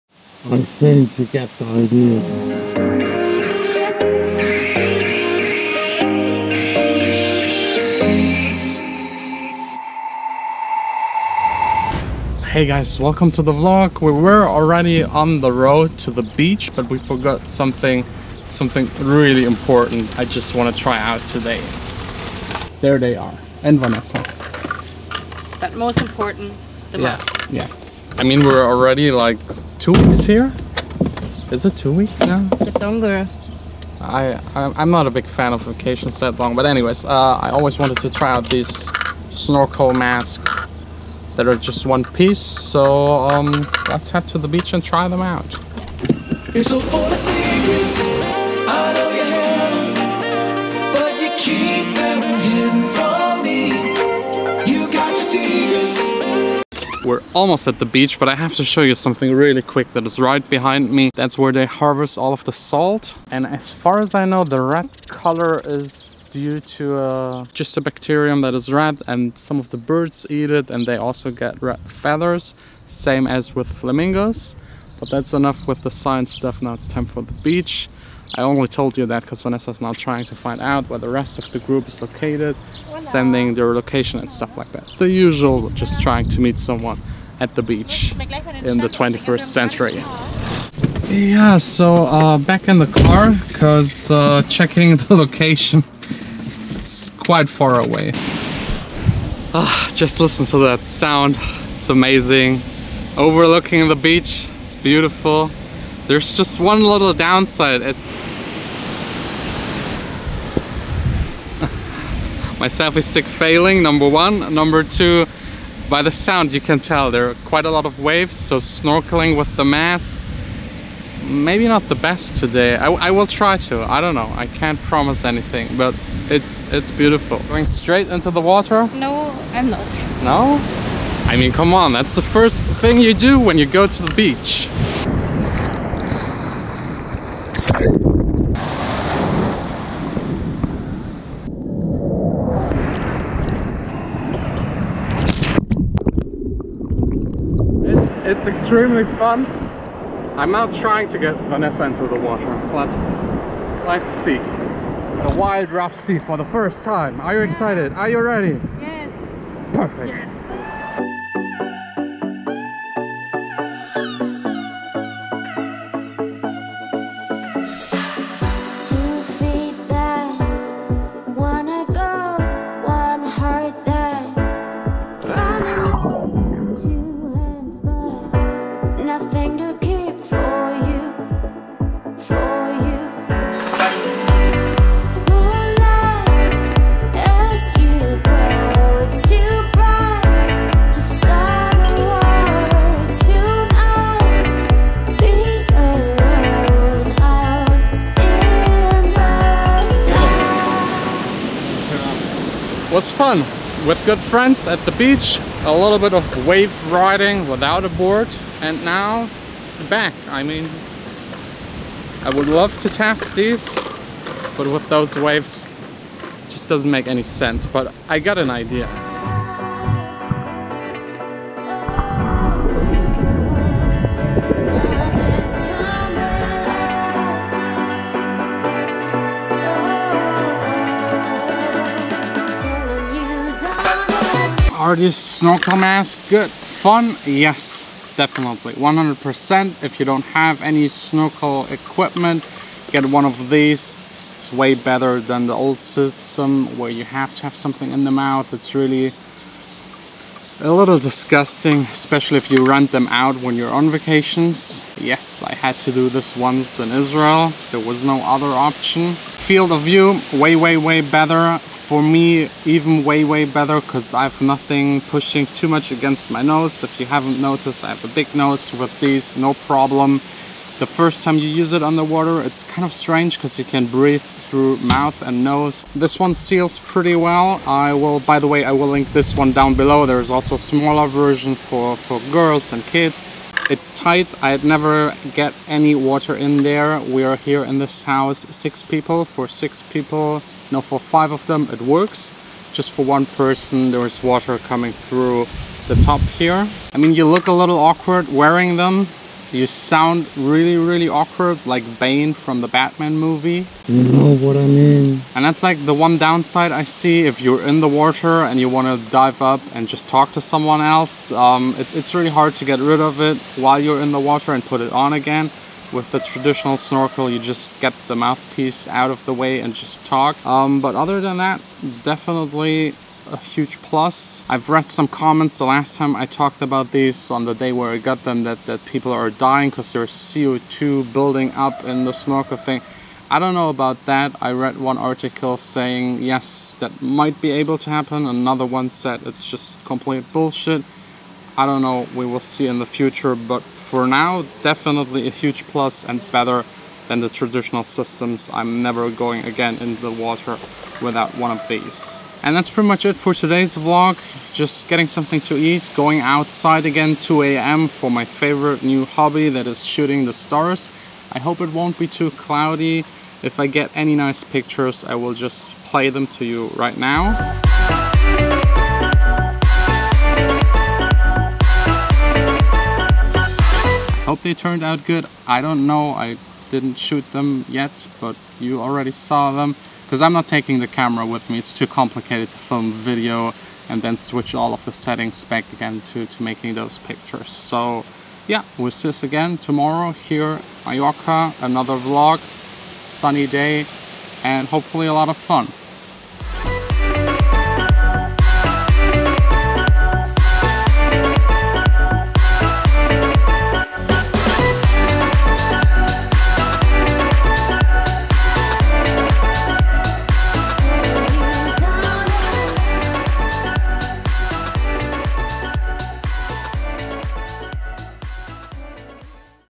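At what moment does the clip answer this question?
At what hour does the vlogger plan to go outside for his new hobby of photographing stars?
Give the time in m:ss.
5:57.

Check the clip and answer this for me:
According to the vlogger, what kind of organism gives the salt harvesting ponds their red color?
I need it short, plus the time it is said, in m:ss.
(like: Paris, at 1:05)
a bacterium, at 1:07.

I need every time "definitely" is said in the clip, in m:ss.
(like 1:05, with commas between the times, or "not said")
3:58, 5:22, 5:44.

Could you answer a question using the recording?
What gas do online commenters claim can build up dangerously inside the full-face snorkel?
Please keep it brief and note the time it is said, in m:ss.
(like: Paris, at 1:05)
CO2, at 5:30.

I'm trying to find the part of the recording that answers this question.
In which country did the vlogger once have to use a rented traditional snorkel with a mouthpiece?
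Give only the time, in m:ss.
4:16.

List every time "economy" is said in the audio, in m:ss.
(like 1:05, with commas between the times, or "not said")
not said.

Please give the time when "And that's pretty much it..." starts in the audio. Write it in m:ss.
5:52.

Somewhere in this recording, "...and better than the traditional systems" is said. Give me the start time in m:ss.
5:46.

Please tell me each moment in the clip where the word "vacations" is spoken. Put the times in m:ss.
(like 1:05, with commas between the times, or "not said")
0:35, 4:13.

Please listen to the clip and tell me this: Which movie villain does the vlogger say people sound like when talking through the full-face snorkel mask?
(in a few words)
Bane.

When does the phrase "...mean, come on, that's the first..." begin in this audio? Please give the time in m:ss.
2:11.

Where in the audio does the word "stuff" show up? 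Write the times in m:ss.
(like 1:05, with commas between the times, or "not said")
1:16, 1:24.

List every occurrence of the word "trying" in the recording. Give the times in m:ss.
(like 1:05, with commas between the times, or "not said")
1:19, 1:26, 2:30.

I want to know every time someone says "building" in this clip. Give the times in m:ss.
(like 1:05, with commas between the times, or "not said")
5:31.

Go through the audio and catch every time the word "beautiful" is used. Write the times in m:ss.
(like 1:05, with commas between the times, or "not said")
1:44, 2:06.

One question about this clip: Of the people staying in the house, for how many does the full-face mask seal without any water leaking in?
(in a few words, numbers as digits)
5.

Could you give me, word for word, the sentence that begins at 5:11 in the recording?
Um, it, it's really hard to get rid of it while you're in the water and put it on again.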